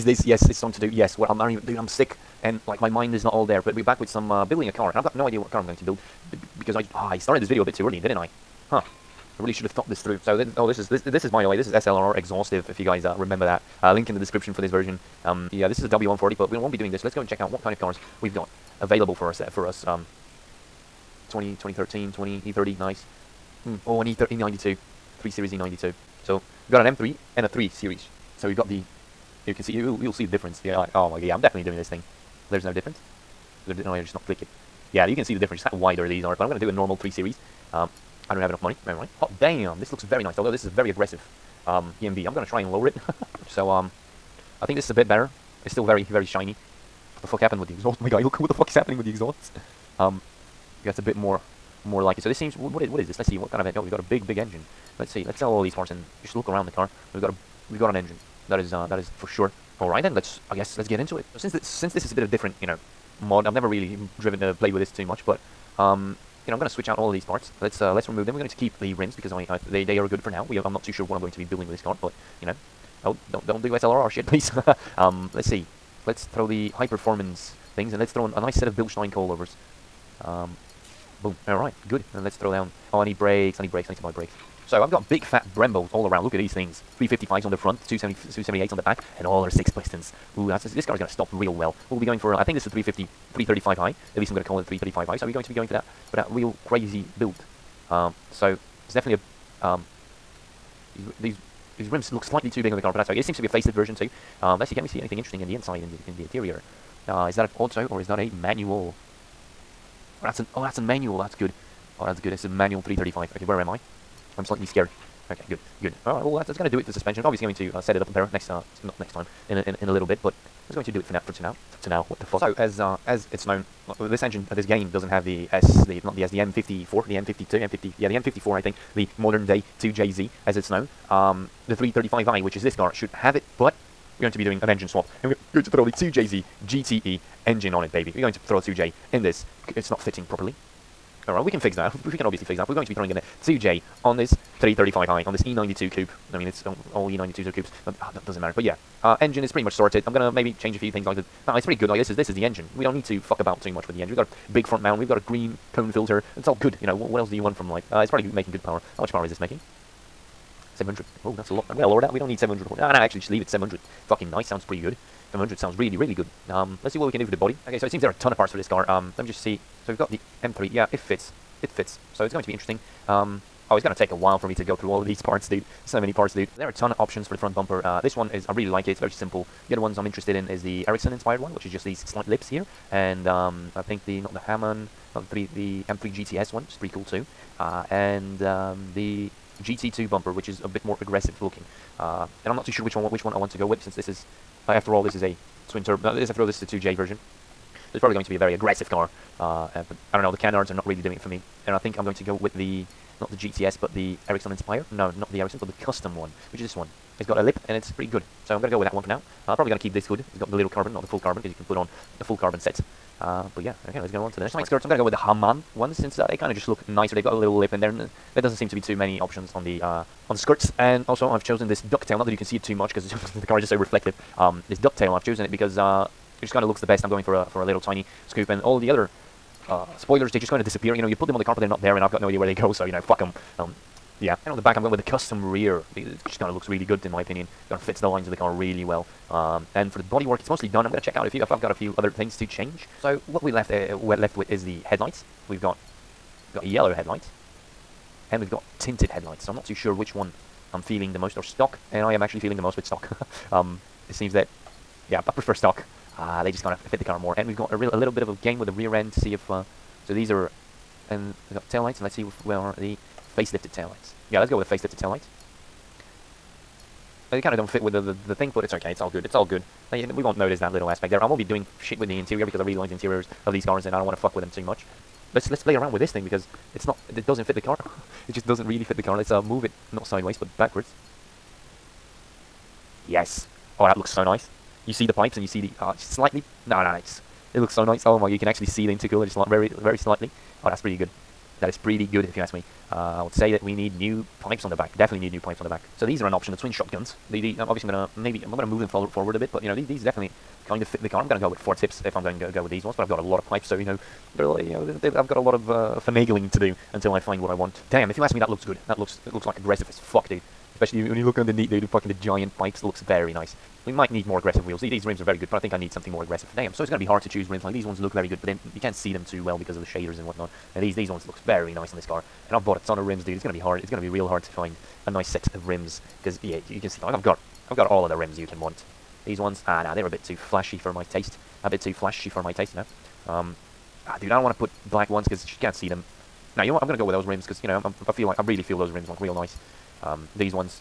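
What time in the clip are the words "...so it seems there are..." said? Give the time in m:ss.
2:47.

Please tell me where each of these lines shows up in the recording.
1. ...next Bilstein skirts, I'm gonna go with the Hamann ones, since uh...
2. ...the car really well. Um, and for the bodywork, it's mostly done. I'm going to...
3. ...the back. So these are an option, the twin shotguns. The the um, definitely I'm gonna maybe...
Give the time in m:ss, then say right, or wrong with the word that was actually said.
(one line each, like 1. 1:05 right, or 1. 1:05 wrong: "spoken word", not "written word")
1. 3:34 wrong: "Side", not "Bilstein"
2. 3:58 right
3. 4:55 wrong: "obviously", not "definitely".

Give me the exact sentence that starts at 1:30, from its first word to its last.
Ooh, this car is going to stop real well.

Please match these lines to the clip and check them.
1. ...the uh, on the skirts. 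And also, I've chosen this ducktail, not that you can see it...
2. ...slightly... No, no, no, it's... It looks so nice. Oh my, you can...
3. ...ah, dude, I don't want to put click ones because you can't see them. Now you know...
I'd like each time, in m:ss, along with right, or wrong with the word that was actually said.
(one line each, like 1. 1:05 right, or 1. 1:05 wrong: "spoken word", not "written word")
1. 3:39 right
2. 4:45 right
3. 5:34 wrong: "black", not "click".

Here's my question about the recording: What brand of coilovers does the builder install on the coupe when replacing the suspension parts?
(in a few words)
Bilstein.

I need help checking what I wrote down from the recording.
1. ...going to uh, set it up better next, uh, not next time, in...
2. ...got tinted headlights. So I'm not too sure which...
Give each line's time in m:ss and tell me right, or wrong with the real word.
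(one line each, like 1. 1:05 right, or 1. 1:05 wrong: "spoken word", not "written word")
1. 1:57 right
2. 4:08 right.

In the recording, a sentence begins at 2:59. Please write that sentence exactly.
The other ones I'm interested in is the Ericsson inspired one, which is just these slight lips here.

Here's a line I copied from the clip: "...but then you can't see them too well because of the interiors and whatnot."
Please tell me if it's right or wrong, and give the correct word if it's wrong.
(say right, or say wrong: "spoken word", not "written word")
wrong: "shaders", not "interiors".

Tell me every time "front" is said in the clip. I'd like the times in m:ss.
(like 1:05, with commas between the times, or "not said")
1:27, 2:34, 2:57.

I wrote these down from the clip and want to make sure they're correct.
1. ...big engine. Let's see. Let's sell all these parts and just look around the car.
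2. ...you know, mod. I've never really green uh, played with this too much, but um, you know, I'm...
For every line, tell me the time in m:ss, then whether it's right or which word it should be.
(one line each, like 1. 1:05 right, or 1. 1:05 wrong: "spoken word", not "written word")
1. 0:54 right
2. 1:02 wrong: "driven", not "green".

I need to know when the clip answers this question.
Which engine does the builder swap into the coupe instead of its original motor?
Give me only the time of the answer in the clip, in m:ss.
2:15.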